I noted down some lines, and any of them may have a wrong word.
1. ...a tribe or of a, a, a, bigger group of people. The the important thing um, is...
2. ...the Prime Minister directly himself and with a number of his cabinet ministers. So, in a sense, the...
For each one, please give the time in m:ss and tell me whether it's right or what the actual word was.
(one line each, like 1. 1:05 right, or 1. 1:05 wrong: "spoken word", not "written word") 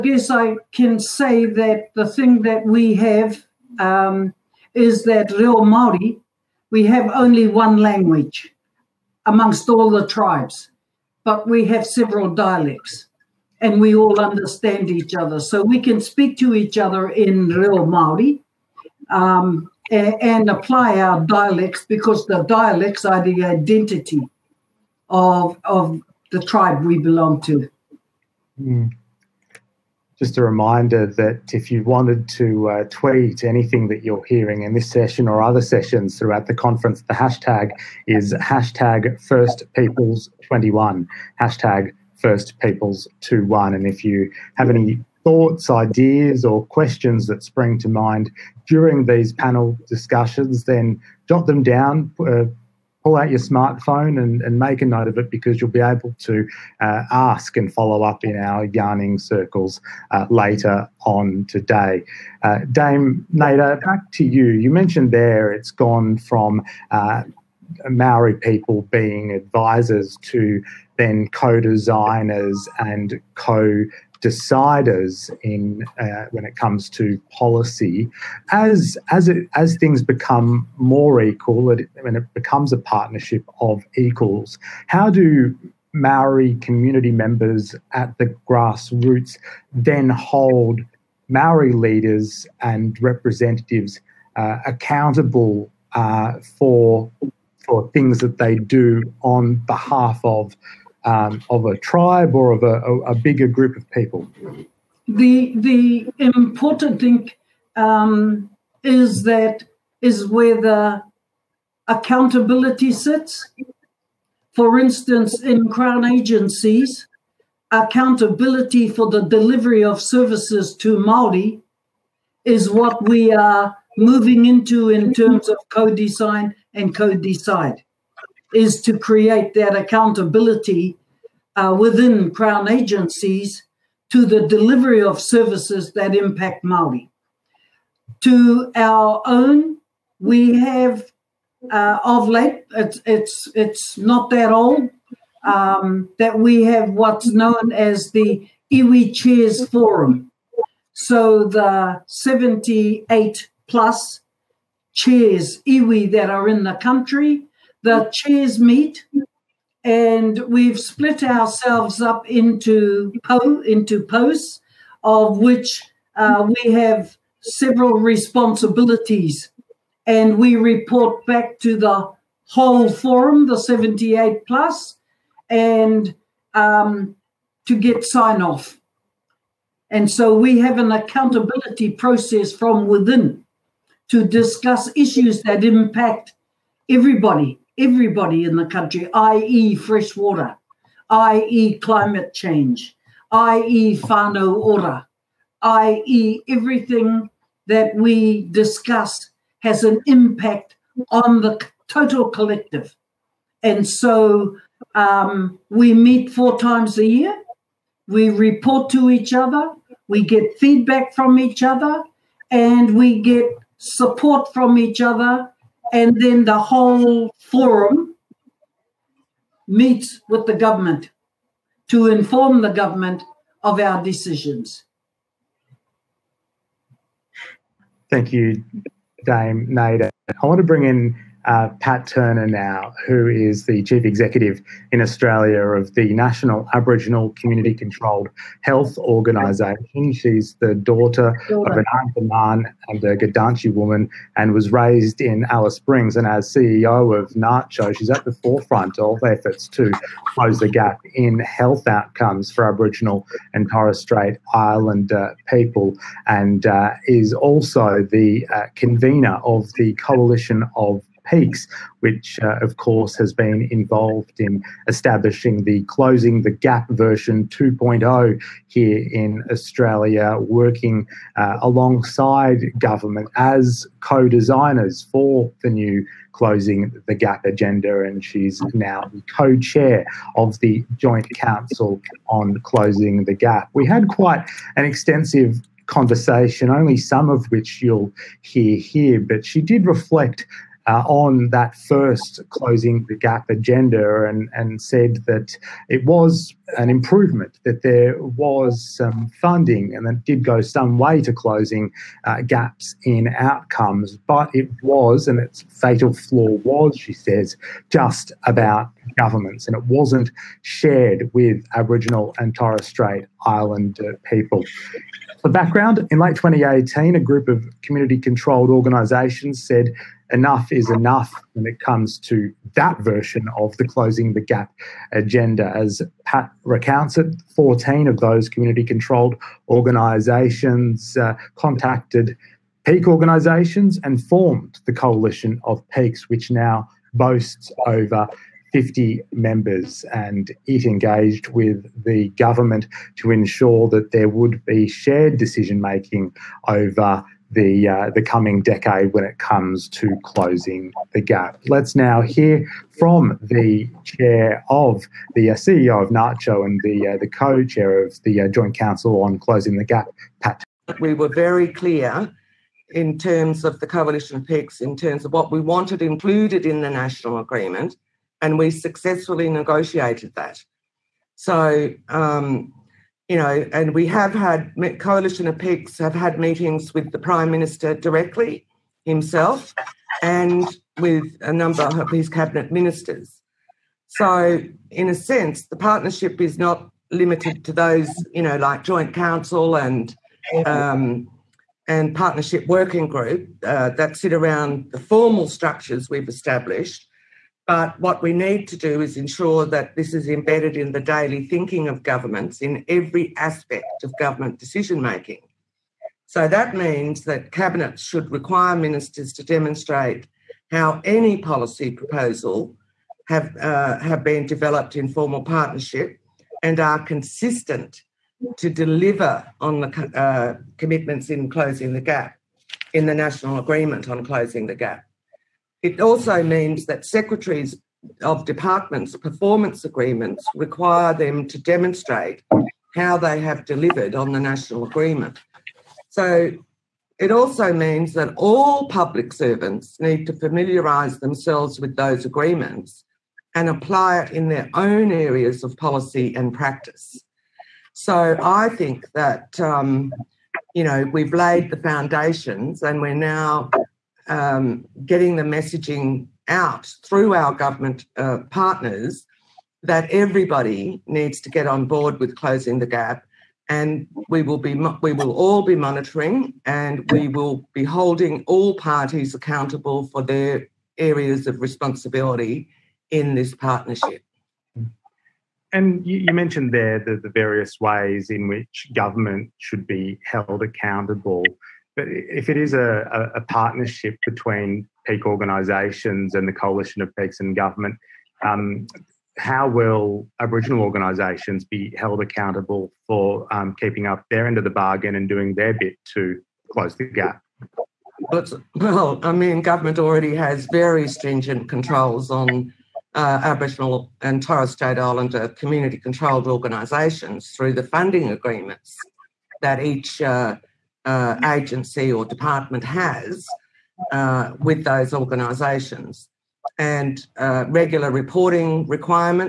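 1. 1:41 right
2. 6:17 right.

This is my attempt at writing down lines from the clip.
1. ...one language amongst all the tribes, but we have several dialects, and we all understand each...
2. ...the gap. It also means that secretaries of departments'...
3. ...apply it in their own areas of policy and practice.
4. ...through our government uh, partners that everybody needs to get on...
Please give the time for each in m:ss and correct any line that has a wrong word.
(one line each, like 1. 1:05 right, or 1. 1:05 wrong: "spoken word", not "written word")
1. 0:07 right
2. 7:04 right
3. 7:23 right
4. 7:37 right.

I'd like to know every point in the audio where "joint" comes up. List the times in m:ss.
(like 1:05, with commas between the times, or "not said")
4:40, 5:58, 6:28.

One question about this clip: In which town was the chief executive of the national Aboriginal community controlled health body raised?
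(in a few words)
Alice Springs.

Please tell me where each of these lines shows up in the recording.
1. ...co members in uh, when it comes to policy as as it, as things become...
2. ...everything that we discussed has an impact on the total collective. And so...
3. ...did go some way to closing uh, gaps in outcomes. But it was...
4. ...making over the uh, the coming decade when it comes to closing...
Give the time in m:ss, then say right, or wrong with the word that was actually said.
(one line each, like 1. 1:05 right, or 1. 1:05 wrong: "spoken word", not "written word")
1. 1:13 wrong: "deciders", not "members"
2. 3:16 right
3. 5:00 right
4. 5:45 right.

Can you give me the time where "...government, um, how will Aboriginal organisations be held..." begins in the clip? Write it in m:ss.
8:07.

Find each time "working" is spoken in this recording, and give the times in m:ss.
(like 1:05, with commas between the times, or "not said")
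4:30, 6:32.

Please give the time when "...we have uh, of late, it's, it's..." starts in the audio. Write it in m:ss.
2:20.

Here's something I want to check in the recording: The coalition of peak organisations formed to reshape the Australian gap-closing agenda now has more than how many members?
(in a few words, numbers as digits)
50.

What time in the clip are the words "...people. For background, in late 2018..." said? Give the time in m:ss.
5:14.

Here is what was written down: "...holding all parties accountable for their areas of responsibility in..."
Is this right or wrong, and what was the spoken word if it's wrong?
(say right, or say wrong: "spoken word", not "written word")
right.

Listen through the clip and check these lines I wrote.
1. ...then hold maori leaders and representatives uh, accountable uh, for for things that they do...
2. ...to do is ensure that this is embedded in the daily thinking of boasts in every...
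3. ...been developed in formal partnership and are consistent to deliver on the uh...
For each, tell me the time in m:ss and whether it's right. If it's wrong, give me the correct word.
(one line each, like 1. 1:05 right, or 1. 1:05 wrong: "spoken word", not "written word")
1. 1:29 right
2. 6:38 wrong: "governments", not "boasts"
3. 6:54 right.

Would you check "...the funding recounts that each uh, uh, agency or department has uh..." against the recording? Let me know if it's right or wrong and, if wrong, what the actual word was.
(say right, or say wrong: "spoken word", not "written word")
wrong: "agreements", not "recounts".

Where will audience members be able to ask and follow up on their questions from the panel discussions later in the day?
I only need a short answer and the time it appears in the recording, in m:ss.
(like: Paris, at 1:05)
yarning circles, at 0:58.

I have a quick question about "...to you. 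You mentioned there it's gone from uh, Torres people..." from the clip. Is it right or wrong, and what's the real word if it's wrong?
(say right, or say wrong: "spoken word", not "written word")
wrong: "Maori", not "Torres".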